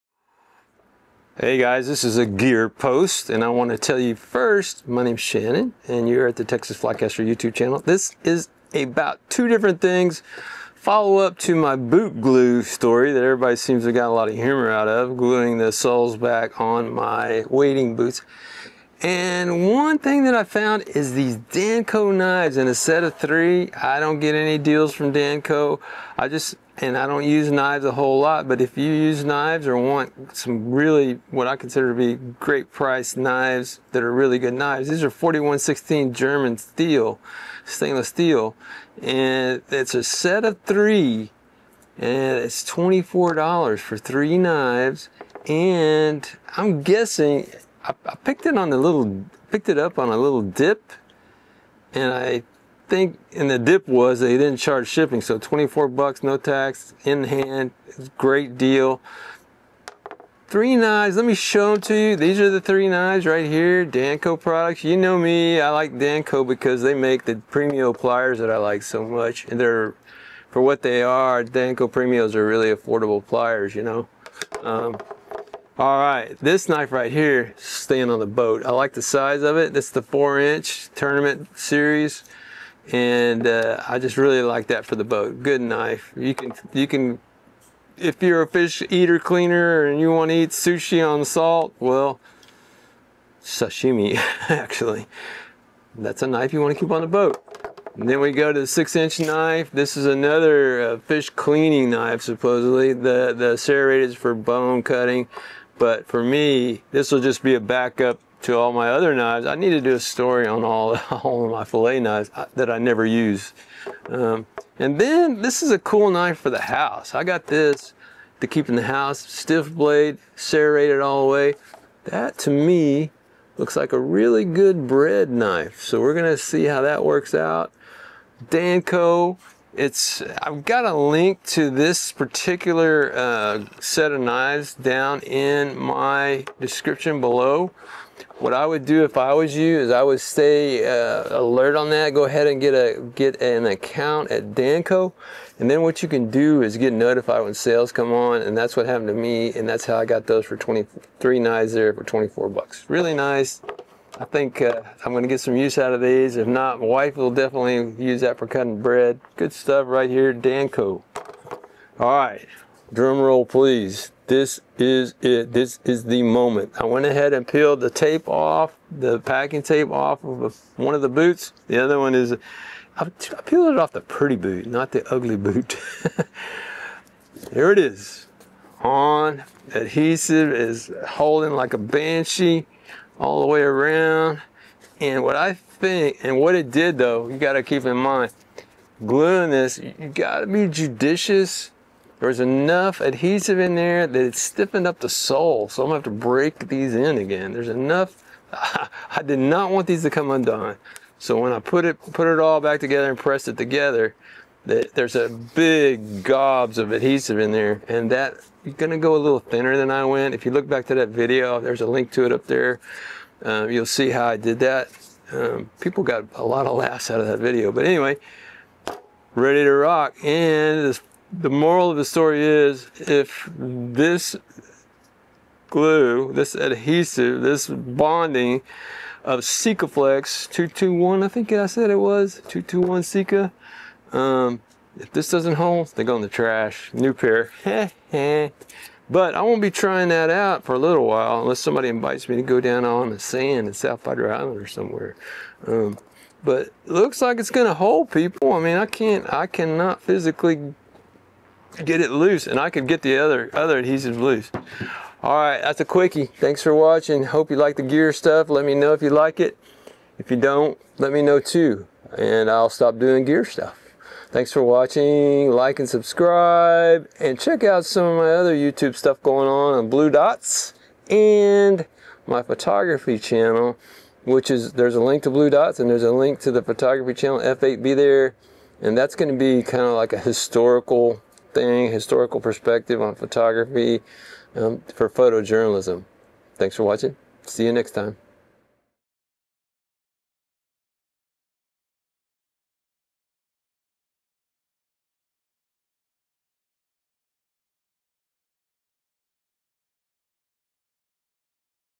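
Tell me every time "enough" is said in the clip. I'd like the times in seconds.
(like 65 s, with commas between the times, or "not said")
192 s, 197 s.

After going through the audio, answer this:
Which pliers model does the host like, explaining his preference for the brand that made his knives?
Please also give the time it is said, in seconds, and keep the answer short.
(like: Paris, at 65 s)
Premio, at 67 s.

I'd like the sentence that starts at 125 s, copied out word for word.
So we're gonna see how that works out.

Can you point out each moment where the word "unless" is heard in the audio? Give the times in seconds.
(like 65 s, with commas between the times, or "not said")
241 s.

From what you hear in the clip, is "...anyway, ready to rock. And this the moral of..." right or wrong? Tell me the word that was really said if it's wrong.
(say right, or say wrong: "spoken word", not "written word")
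right.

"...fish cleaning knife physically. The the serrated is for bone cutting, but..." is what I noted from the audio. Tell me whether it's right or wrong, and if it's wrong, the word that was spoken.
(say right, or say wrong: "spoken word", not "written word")
wrong: "supposedly", not "physically".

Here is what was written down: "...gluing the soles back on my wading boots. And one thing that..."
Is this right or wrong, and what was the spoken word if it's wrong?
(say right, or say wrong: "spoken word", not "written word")
right.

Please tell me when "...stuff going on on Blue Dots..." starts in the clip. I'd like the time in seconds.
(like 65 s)
268 s.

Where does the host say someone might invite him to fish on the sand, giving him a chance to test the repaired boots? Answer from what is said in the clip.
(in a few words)
South Padre Island.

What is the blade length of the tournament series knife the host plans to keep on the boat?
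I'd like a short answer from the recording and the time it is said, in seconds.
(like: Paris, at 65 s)
4 inch, at 80 s.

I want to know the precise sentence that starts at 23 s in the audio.
I don't get any deals from Danco.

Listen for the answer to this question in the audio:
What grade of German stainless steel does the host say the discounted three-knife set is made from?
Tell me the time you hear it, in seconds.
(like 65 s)
35 s.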